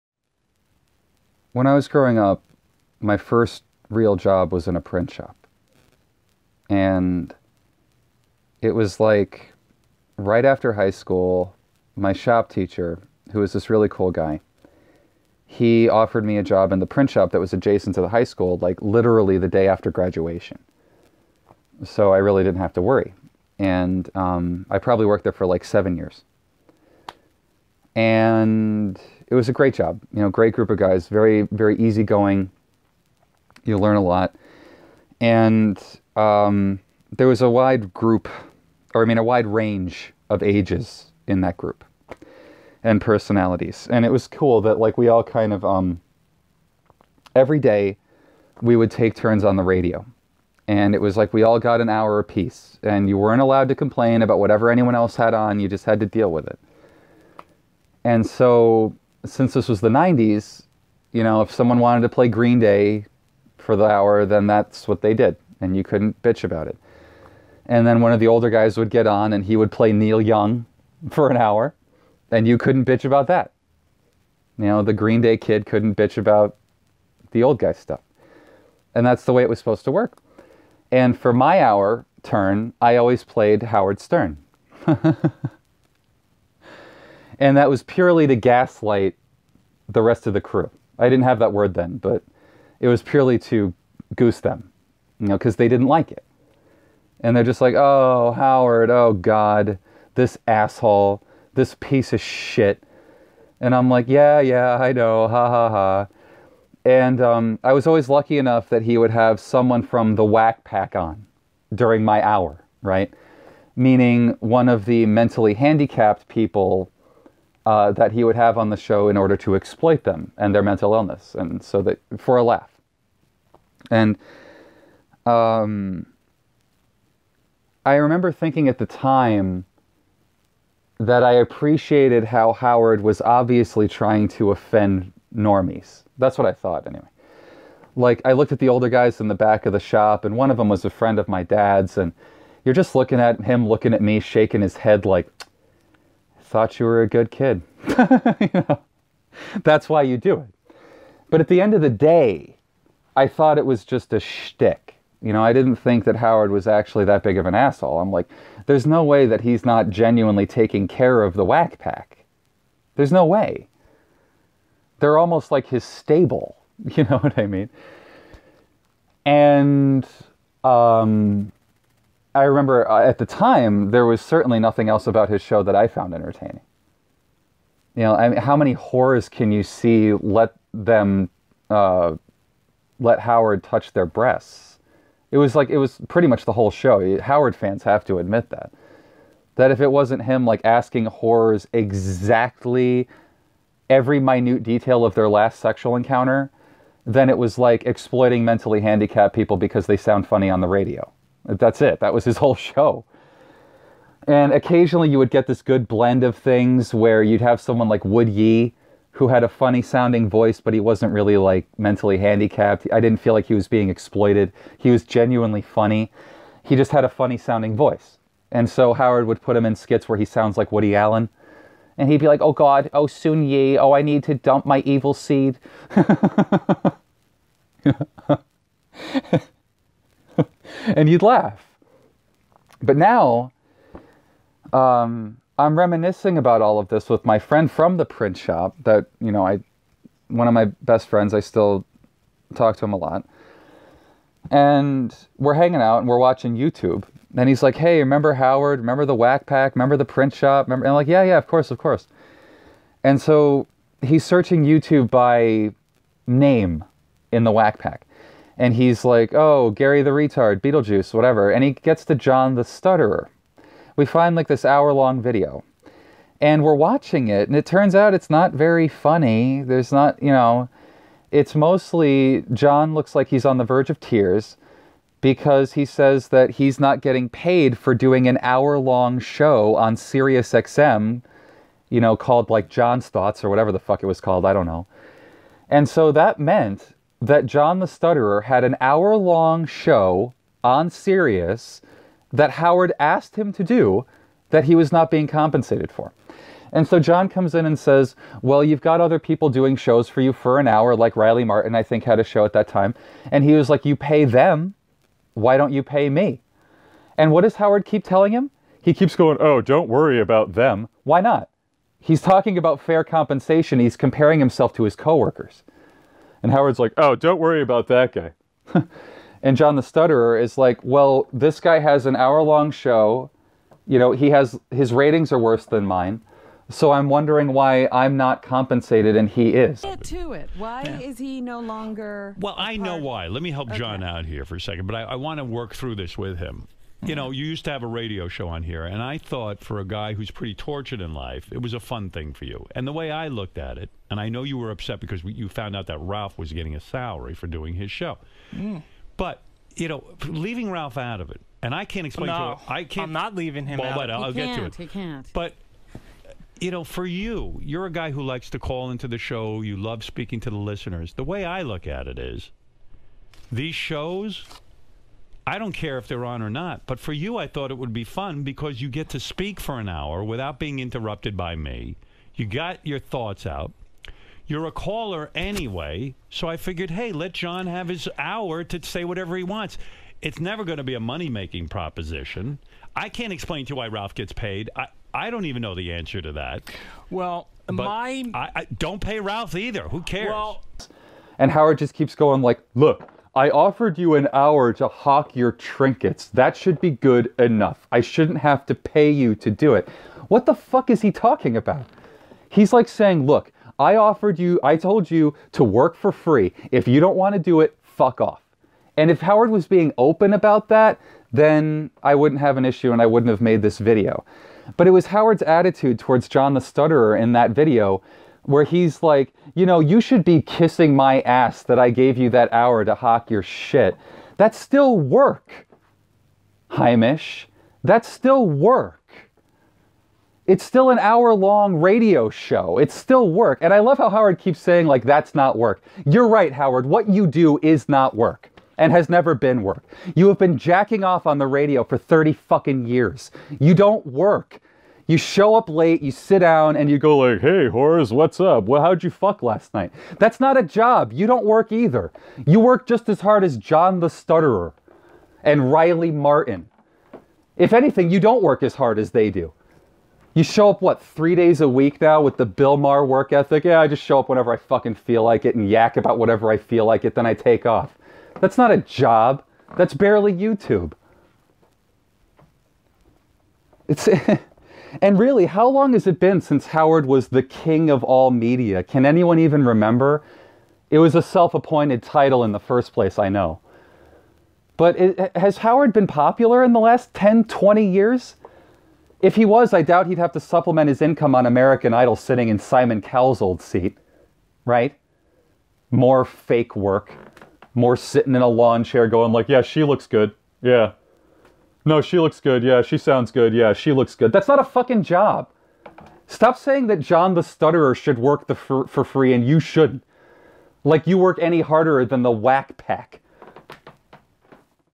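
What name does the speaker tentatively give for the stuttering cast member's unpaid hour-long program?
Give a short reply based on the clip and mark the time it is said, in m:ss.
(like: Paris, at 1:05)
John's Thoughts, at 4:42.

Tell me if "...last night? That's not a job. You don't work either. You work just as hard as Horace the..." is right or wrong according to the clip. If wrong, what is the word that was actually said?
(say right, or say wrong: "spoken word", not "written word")
wrong: "John", not "Horace".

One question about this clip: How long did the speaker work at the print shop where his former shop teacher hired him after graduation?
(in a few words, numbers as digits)
7 years.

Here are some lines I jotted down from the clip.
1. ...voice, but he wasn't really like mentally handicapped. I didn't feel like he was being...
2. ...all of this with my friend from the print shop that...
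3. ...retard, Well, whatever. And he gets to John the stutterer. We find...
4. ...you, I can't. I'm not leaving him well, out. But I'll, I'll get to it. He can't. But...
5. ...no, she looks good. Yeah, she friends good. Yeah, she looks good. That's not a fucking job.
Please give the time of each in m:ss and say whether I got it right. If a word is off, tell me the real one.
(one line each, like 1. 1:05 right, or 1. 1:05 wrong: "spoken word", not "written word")
1. 3:30 right
2. 3:56 right
3. 4:20 wrong: "Beetlejuice", not "Well"
4. 5:52 right
5. 8:21 wrong: "sounds", not "friends".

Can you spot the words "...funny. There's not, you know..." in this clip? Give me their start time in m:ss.
4:28.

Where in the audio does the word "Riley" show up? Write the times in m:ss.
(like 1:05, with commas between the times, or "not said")
5:01, 7:35.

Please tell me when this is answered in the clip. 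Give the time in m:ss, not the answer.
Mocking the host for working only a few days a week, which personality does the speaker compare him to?
7:42.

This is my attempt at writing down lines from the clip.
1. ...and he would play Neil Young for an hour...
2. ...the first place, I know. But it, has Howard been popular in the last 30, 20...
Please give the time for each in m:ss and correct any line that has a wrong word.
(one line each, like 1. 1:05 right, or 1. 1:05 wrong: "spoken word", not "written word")
1. 1:09 right
2. 8:02 wrong: "10", not "30".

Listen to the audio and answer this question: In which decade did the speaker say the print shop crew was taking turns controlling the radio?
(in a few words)
the 90s.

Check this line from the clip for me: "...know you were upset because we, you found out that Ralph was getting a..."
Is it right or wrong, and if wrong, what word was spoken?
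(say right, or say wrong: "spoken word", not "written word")
right.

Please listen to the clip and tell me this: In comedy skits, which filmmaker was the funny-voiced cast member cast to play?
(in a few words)
Woody Allen.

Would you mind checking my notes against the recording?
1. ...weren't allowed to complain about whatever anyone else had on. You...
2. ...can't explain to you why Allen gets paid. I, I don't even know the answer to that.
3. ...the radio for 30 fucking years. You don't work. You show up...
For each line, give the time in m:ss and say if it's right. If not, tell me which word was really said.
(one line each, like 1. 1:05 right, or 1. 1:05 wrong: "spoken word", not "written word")
1. 0:53 right
2. 6:23 wrong: "Ralph", not "Allen"
3. 7:21 right.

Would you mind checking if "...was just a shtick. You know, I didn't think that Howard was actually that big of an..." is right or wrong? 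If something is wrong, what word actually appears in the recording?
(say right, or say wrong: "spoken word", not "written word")
right.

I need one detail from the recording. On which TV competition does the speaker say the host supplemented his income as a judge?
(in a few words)
American Idol.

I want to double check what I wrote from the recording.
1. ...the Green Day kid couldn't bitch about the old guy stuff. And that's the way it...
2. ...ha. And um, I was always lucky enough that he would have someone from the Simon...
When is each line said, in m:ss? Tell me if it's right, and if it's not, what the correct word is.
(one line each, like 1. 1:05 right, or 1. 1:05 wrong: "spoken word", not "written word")
1. 1:14 right
2. 1:45 wrong: "Wack", not "Simon".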